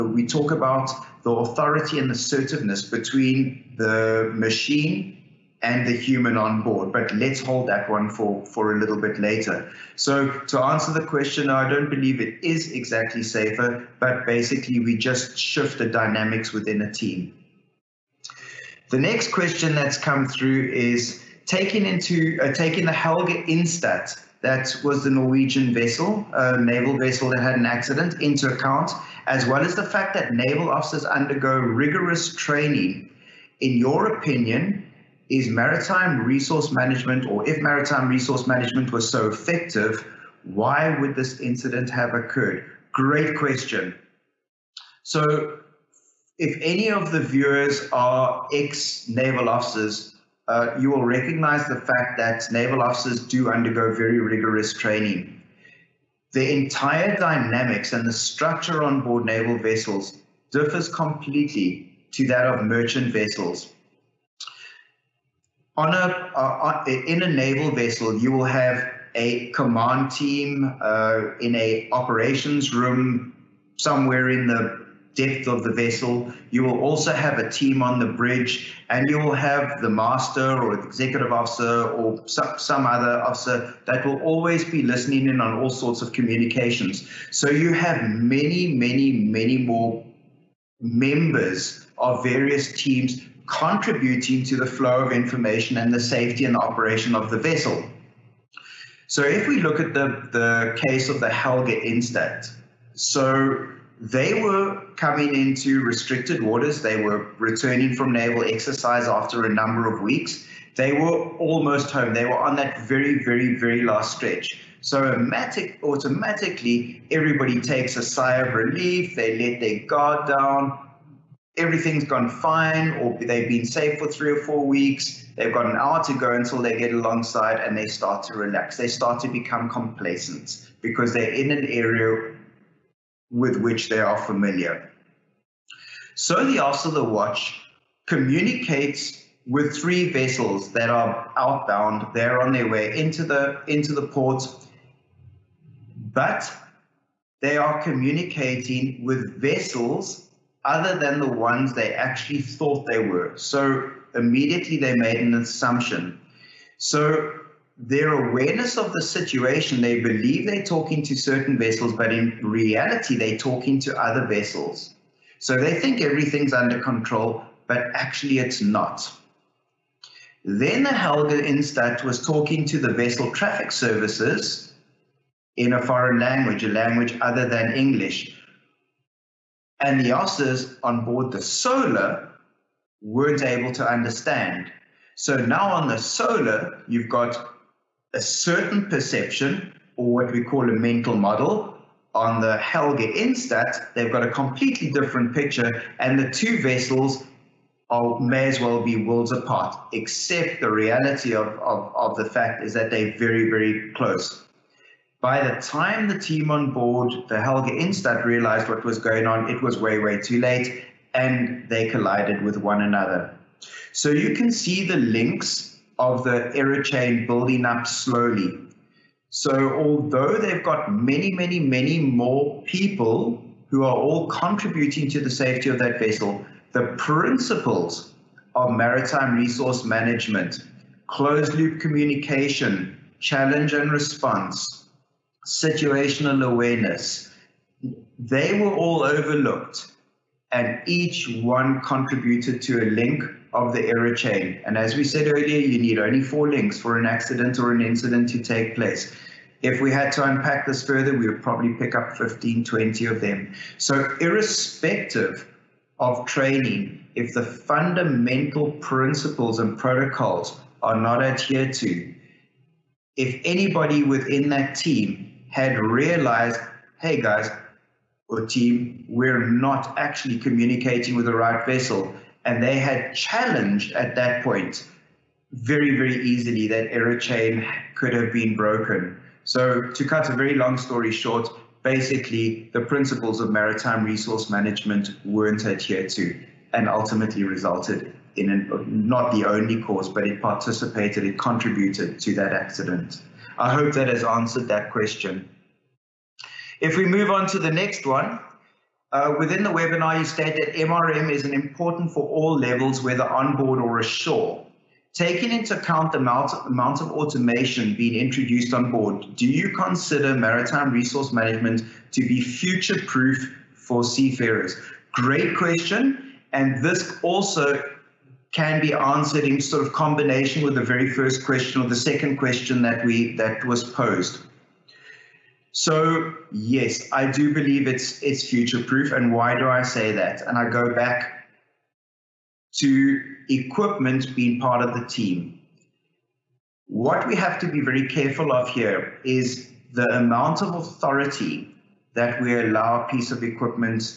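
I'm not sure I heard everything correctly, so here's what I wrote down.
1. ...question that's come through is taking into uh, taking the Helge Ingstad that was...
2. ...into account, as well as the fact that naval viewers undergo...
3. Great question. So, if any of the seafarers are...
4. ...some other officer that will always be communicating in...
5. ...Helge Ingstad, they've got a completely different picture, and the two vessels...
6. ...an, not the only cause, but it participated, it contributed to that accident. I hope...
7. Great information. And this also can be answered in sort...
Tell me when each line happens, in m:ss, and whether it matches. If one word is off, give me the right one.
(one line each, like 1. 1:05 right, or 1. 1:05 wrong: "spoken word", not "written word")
1. 0:19 right
2. 0:28 wrong: "officers", not "viewers"
3. 0:42 wrong: "viewers", not "seafarers"
4. 1:22 wrong: "listening", not "communicating"
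5. 3:12 right
6. 4:48 right
7. 5:15 wrong: "question", not "information".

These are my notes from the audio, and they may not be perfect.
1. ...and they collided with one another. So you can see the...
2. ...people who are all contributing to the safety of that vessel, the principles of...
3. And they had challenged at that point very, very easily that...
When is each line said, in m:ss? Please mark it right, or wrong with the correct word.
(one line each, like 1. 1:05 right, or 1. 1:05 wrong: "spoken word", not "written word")
1. 3:31 right
2. 3:42 right
3. 4:32 right.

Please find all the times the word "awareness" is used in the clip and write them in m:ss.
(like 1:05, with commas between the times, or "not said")
2:38, 3:56.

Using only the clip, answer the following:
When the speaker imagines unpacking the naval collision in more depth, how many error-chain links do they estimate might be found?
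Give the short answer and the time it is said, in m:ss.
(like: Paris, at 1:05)
15 to 20, at 4:12.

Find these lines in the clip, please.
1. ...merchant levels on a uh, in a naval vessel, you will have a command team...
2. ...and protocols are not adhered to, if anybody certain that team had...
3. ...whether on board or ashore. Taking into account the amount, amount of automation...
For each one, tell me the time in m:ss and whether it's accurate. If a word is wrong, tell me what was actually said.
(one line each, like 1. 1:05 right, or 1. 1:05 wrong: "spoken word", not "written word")
1. 1:02 wrong: "vessels", not "levels"
2. 4:19 wrong: "within", not "certain"
3. 5:03 right.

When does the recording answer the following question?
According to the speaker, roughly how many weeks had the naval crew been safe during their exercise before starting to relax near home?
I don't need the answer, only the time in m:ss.
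2:04.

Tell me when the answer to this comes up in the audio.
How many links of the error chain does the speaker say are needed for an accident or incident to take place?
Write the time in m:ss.
4:06.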